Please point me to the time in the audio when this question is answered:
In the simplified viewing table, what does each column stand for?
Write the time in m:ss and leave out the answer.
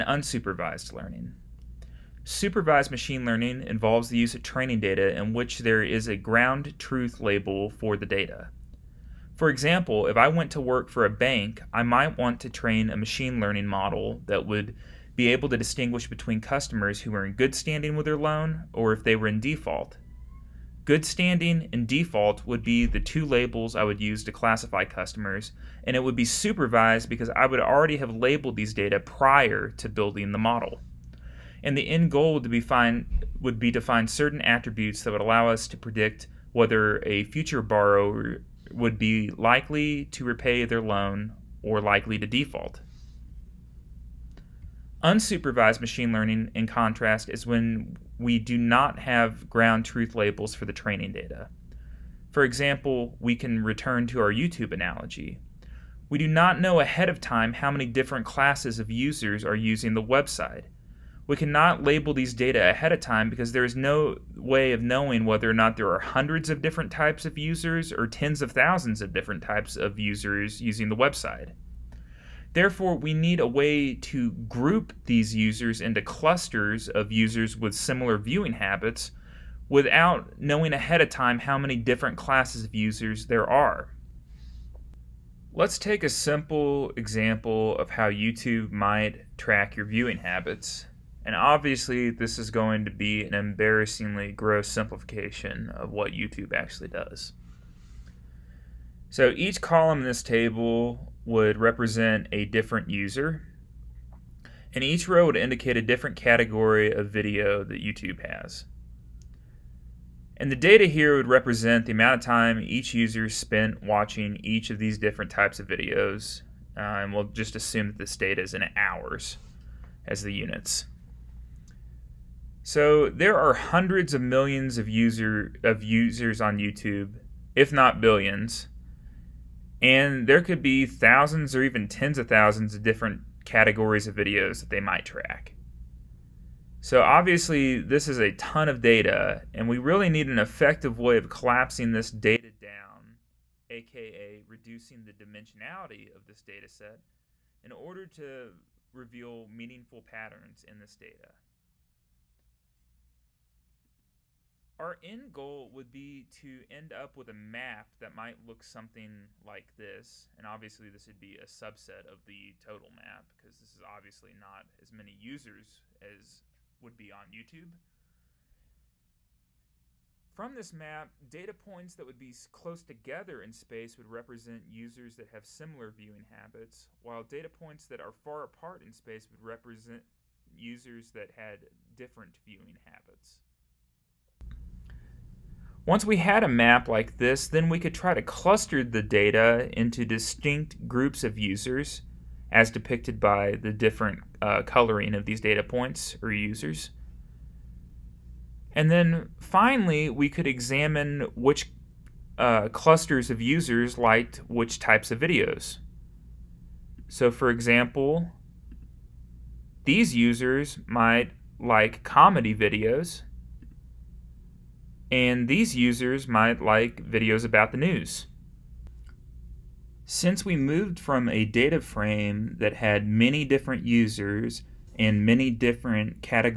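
1:42.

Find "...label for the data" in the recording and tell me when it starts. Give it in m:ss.
0:07.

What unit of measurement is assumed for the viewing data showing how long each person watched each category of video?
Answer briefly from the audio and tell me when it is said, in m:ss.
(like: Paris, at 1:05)
Hours, at 1:58.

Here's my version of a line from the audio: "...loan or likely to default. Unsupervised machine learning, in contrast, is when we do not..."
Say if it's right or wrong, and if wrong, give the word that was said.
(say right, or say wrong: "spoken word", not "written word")
right.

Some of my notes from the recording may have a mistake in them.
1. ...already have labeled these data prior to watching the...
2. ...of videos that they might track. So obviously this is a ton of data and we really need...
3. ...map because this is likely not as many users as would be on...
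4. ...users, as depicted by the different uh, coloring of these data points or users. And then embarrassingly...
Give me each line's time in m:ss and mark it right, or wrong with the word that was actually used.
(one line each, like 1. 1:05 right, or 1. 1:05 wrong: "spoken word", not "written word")
1. 0:27 wrong: "building", not "watching"
2. 2:14 right
3. 2:42 wrong: "obviously", not "likely"
4. 3:11 wrong: "finally", not "embarrassingly".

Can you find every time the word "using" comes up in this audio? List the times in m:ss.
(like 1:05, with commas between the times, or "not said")
0:59, 1:10.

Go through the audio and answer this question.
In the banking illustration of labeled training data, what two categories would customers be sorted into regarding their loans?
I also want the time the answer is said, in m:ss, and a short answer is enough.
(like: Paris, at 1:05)
Good standing and default, at 0:20.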